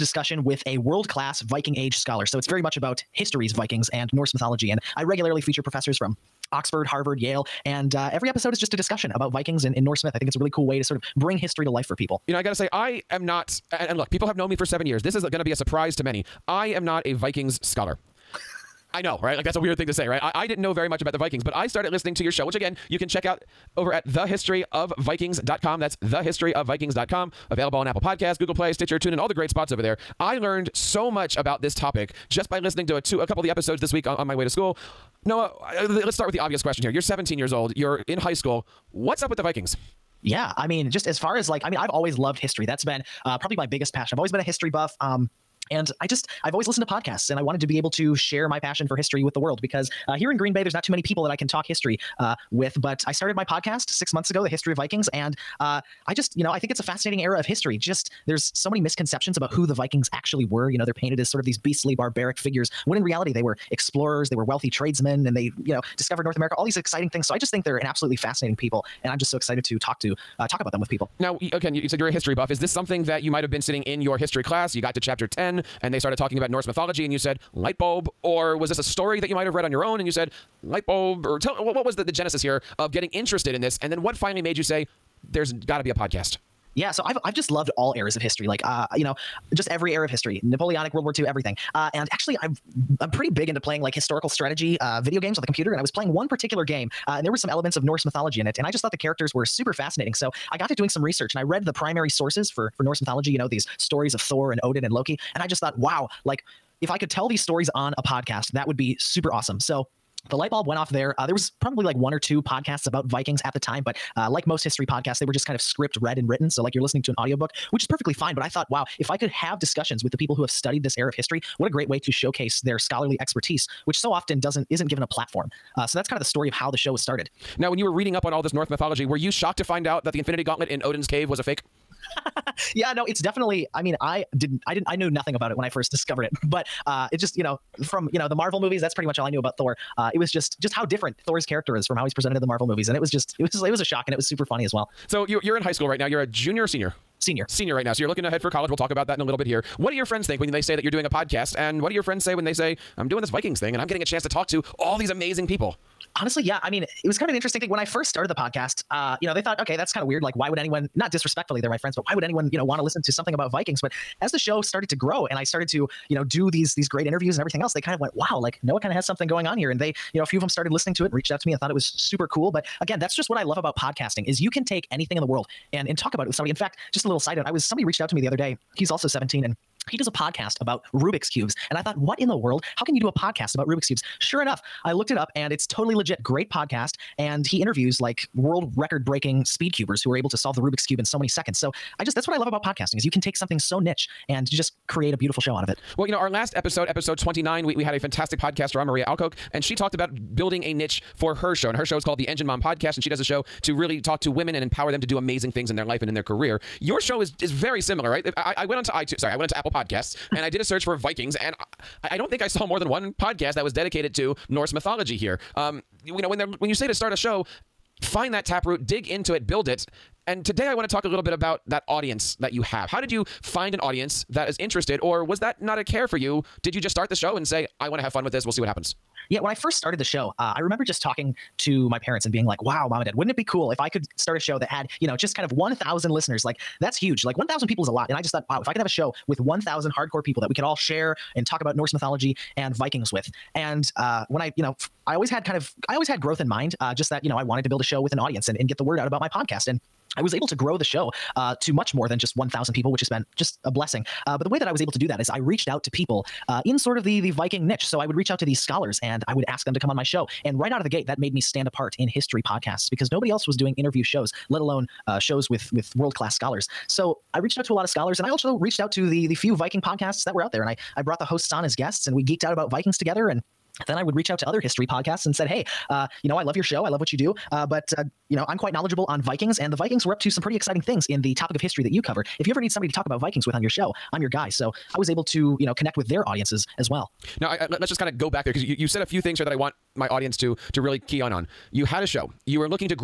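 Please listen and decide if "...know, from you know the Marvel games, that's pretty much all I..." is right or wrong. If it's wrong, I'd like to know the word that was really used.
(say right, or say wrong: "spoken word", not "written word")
wrong: "movies", not "games".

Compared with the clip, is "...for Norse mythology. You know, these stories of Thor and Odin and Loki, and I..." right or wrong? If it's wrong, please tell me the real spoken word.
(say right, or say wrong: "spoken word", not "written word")
right.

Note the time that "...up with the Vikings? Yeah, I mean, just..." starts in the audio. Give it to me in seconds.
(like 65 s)
39 s.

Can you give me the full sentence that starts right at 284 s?
So I was able to, you know, connect with their audiences as well.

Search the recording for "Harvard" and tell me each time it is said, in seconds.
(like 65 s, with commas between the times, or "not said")
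6 s.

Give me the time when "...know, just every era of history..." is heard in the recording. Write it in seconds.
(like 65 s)
89 s.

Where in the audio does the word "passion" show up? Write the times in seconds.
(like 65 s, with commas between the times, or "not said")
43 s, 48 s.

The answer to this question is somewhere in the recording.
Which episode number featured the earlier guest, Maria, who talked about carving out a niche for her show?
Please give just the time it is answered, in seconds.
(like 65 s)
196 s.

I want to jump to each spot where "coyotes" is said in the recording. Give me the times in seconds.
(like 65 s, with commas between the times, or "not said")
not said.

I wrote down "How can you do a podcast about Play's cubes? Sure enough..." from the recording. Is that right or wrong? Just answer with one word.
wrong.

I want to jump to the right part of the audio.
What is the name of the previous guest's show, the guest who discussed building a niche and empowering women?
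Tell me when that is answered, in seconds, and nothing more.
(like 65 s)
202 s.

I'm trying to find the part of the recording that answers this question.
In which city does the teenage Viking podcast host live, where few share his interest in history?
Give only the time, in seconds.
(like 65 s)
50 s.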